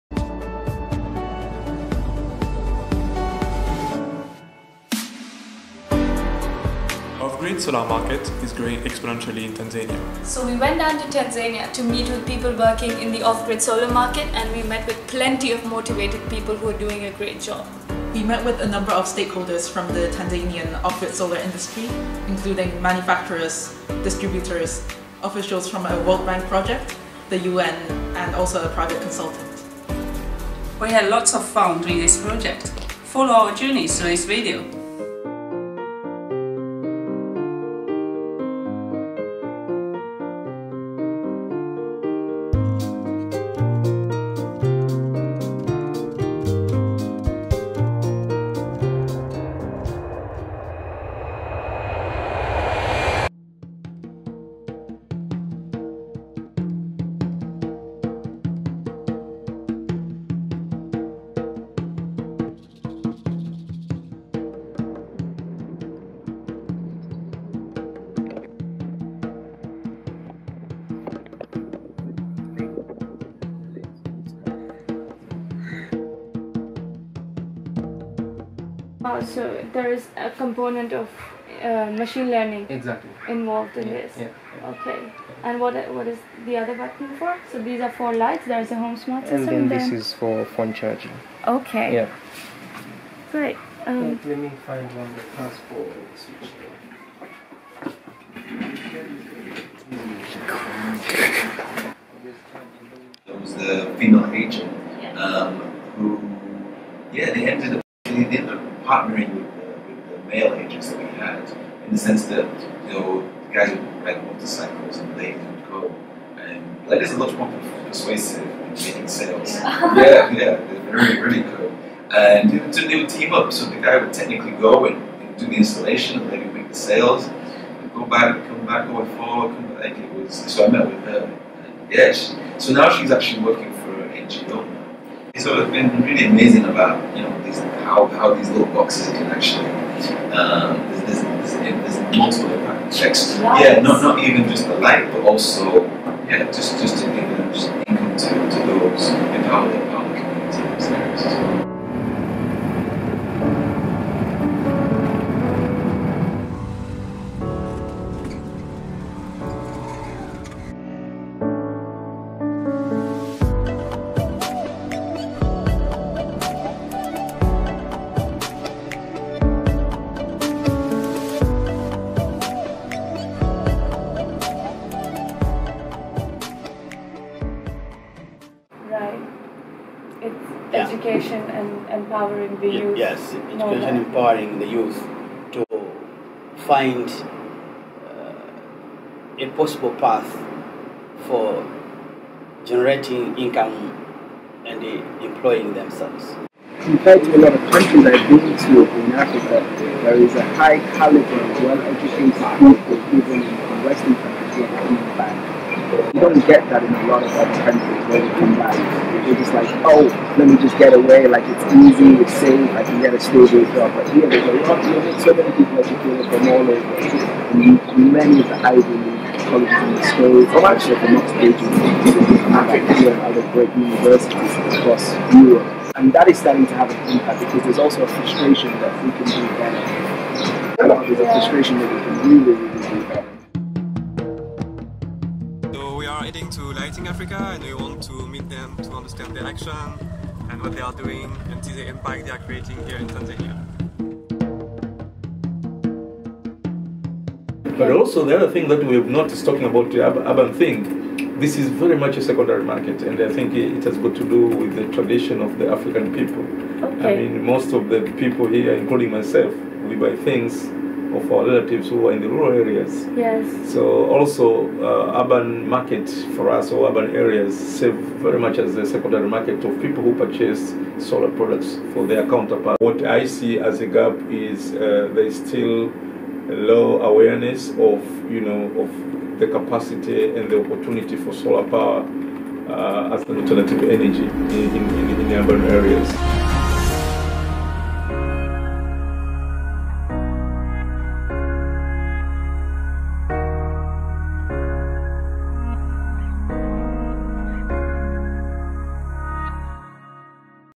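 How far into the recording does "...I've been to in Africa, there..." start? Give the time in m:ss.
3:18.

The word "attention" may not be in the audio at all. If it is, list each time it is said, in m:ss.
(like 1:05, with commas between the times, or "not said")
not said.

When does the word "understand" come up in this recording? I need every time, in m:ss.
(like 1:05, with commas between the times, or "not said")
3:58.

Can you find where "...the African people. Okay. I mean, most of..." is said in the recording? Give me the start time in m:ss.
4:15.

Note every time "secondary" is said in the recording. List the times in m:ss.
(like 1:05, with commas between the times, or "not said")
4:12, 4:28.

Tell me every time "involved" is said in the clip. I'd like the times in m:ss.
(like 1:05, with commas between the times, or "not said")
1:23.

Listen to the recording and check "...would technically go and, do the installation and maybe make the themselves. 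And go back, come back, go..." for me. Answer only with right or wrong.
wrong.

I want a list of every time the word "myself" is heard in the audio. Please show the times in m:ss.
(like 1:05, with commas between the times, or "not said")
4:19.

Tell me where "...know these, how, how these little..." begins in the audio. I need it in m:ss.
2:17.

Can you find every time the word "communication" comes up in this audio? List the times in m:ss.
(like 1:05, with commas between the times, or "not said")
not said.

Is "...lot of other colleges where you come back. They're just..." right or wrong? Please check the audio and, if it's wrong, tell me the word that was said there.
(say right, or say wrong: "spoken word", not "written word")
wrong: "countries", not "colleges".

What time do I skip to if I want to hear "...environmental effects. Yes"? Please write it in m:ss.
2:22.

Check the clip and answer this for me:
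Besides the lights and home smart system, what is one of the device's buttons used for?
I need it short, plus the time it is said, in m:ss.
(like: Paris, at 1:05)
Phone charging, at 1:30.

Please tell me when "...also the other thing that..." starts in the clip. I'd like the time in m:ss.
4:07.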